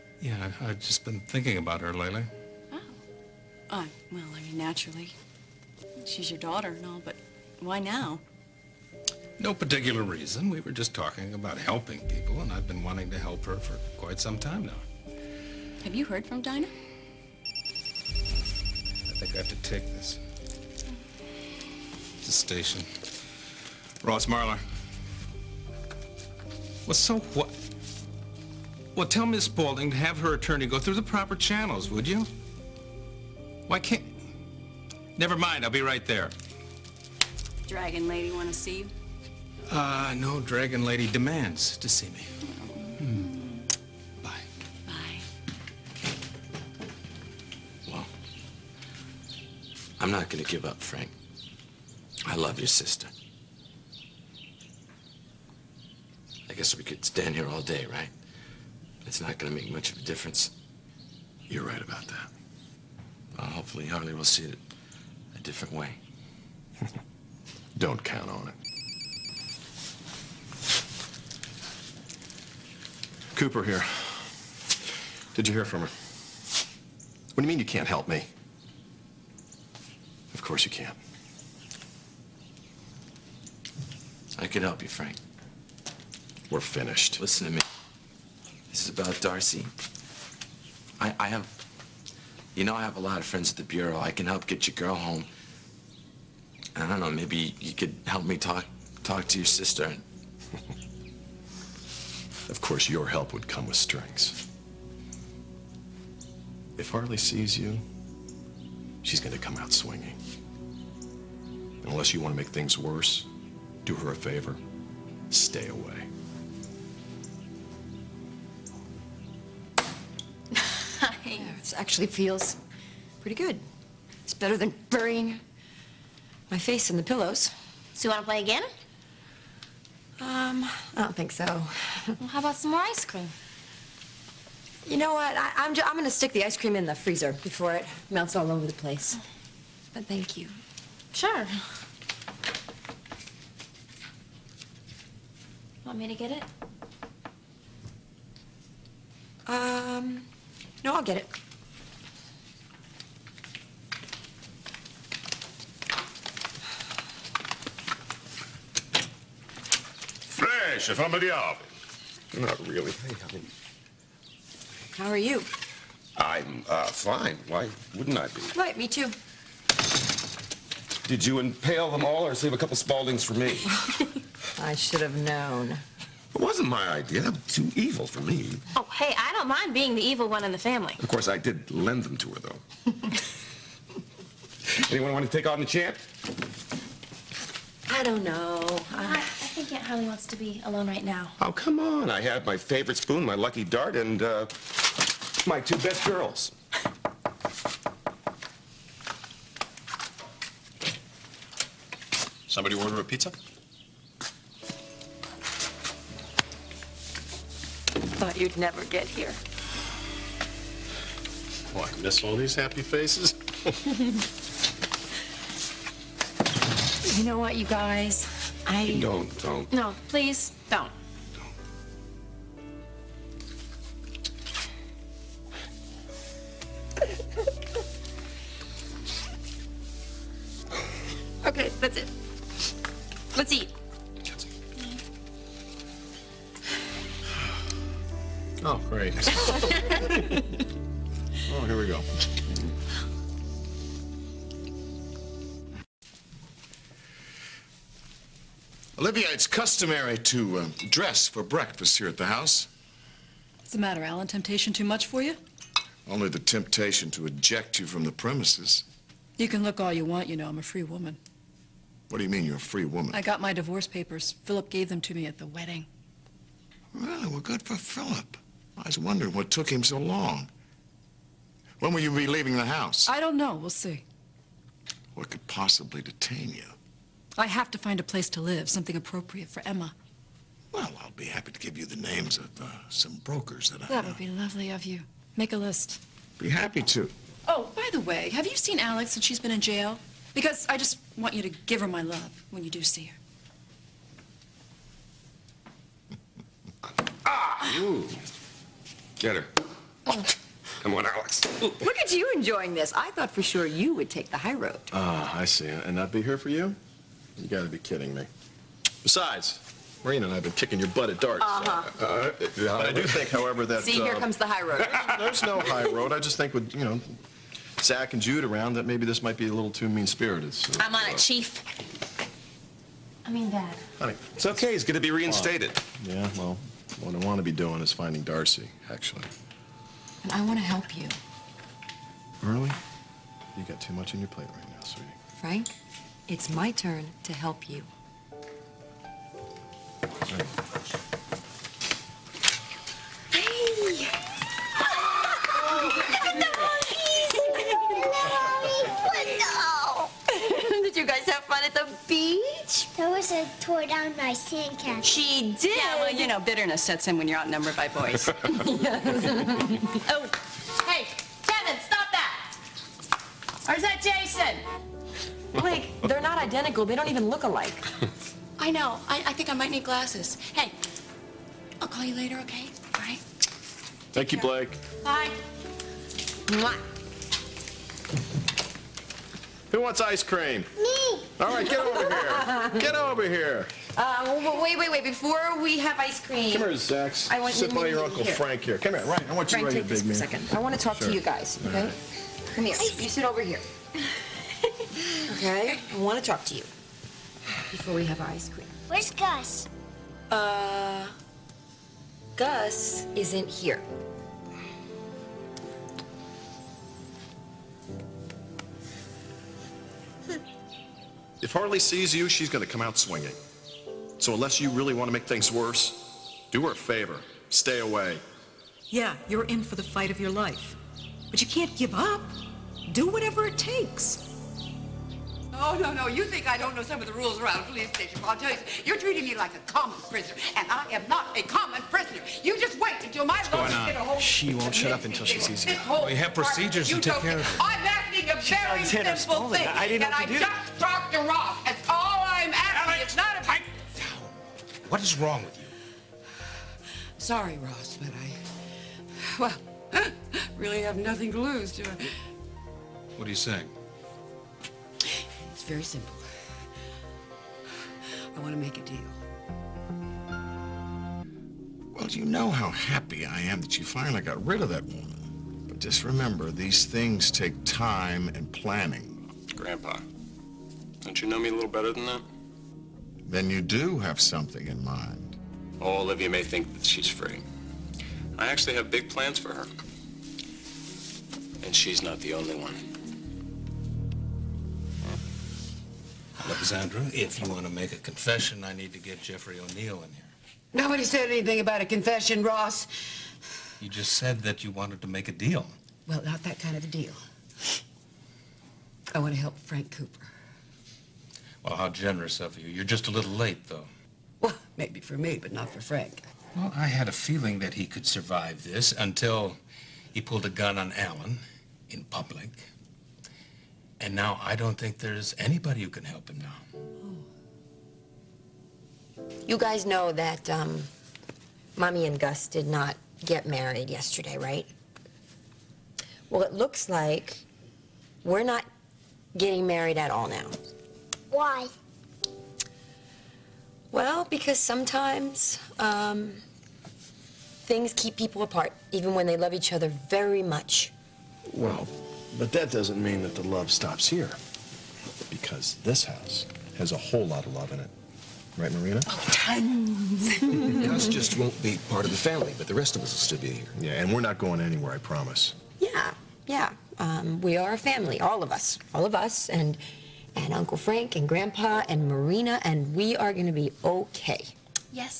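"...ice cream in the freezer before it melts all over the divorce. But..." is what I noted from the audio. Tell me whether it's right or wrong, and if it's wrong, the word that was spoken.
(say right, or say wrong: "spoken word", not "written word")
wrong: "place", not "divorce".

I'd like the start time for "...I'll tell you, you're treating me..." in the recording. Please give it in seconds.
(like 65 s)
428 s.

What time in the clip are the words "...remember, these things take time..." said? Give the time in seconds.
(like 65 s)
466 s.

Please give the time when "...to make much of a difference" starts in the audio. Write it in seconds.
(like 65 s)
59 s.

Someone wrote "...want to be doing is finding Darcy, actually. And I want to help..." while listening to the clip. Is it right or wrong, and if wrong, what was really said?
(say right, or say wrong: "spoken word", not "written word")
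right.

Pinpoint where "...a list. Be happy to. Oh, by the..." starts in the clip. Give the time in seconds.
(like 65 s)
285 s.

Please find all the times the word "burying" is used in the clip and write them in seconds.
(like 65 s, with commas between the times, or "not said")
124 s.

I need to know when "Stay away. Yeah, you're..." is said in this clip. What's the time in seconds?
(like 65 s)
417 s.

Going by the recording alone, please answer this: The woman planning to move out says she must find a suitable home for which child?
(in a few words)
Emma.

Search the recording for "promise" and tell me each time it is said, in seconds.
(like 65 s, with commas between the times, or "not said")
554 s.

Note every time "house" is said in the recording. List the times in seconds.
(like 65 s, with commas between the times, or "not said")
252 s, 272 s, 546 s.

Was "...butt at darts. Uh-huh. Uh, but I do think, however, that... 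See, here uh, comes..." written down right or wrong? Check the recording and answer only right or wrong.
right.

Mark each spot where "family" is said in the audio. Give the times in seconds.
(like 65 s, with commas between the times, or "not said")
180 s, 552 s, 557 s.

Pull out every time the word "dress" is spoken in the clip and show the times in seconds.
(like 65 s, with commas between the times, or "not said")
250 s.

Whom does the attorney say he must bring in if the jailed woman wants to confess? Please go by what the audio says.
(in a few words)
Jeffrey O'Neill.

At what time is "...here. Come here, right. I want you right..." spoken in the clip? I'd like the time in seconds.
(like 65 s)
388 s.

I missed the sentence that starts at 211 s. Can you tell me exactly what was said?
Oh, I miss all these happy faces.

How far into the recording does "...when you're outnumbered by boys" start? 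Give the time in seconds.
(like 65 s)
357 s.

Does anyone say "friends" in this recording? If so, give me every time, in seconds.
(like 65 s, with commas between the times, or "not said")
93 s.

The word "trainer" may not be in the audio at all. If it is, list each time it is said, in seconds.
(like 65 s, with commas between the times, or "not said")
not said.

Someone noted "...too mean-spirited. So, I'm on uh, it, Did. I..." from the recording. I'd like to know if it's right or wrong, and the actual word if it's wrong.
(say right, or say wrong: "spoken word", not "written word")
wrong: "Chief", not "Did".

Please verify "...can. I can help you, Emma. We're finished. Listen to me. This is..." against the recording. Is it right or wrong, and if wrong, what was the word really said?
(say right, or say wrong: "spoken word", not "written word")
wrong: "Frank", not "Emma".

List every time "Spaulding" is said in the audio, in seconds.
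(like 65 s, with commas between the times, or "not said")
29 s, 172 s.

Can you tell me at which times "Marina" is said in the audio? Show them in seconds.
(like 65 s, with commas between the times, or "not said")
310 s, 548 s, 562 s.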